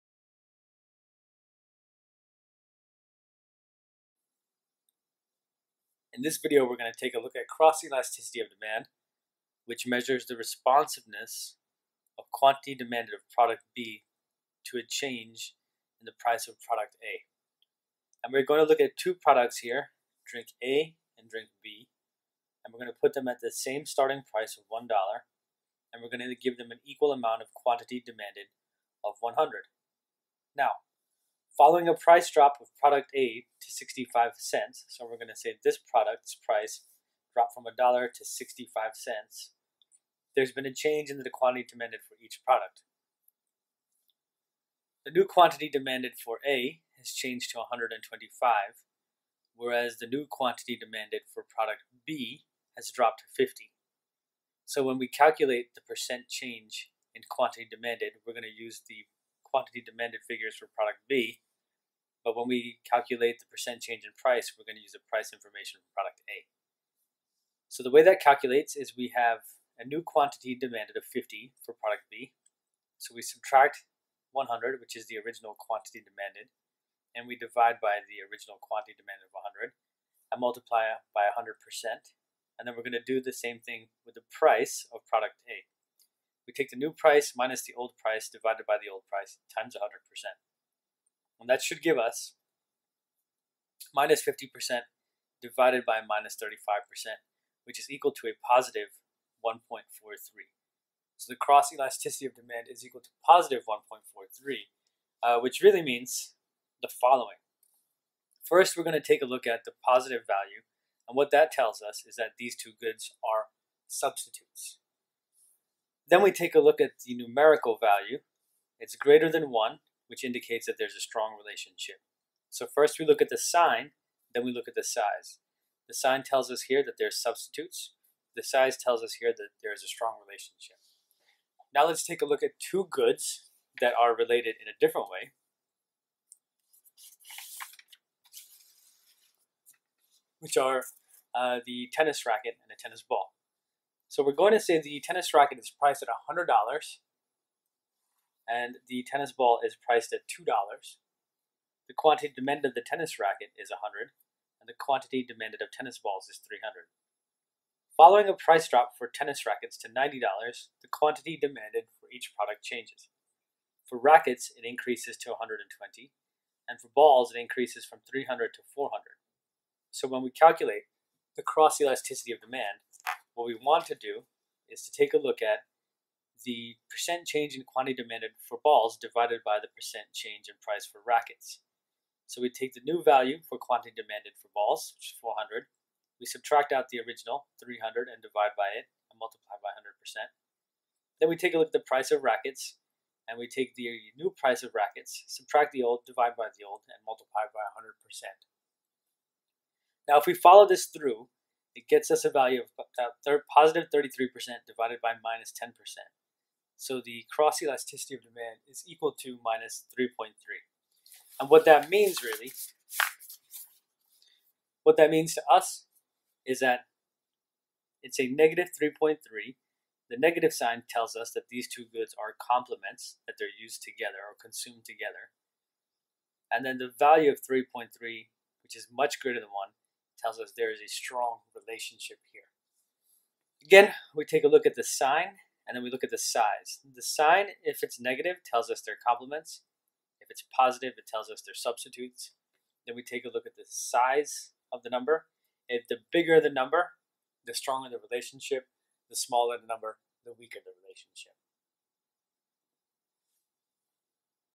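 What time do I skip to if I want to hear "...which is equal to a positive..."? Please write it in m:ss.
1:37.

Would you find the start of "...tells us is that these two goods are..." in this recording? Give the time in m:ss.
1:51.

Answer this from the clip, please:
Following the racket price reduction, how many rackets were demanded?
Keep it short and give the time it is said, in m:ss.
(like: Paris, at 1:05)
120, at 2:45.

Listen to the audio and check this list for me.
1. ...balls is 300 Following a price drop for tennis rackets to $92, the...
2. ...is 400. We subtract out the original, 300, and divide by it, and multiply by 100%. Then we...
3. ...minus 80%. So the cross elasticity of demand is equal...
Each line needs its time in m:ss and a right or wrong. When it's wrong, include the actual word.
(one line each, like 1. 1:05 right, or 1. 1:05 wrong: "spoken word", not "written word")
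1. 2:35 wrong: "90", not "92"
2. 3:05 right
3. 3:25 wrong: "10", not "80".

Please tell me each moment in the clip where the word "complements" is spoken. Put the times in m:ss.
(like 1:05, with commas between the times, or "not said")
3:42, 3:59.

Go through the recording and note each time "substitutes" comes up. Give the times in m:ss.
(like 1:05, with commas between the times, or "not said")
1:53, 2:07, 4:01.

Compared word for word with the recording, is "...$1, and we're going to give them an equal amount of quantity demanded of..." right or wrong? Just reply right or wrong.
right.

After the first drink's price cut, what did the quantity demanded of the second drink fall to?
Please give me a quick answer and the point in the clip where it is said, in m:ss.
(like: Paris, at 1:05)
50, at 0:52.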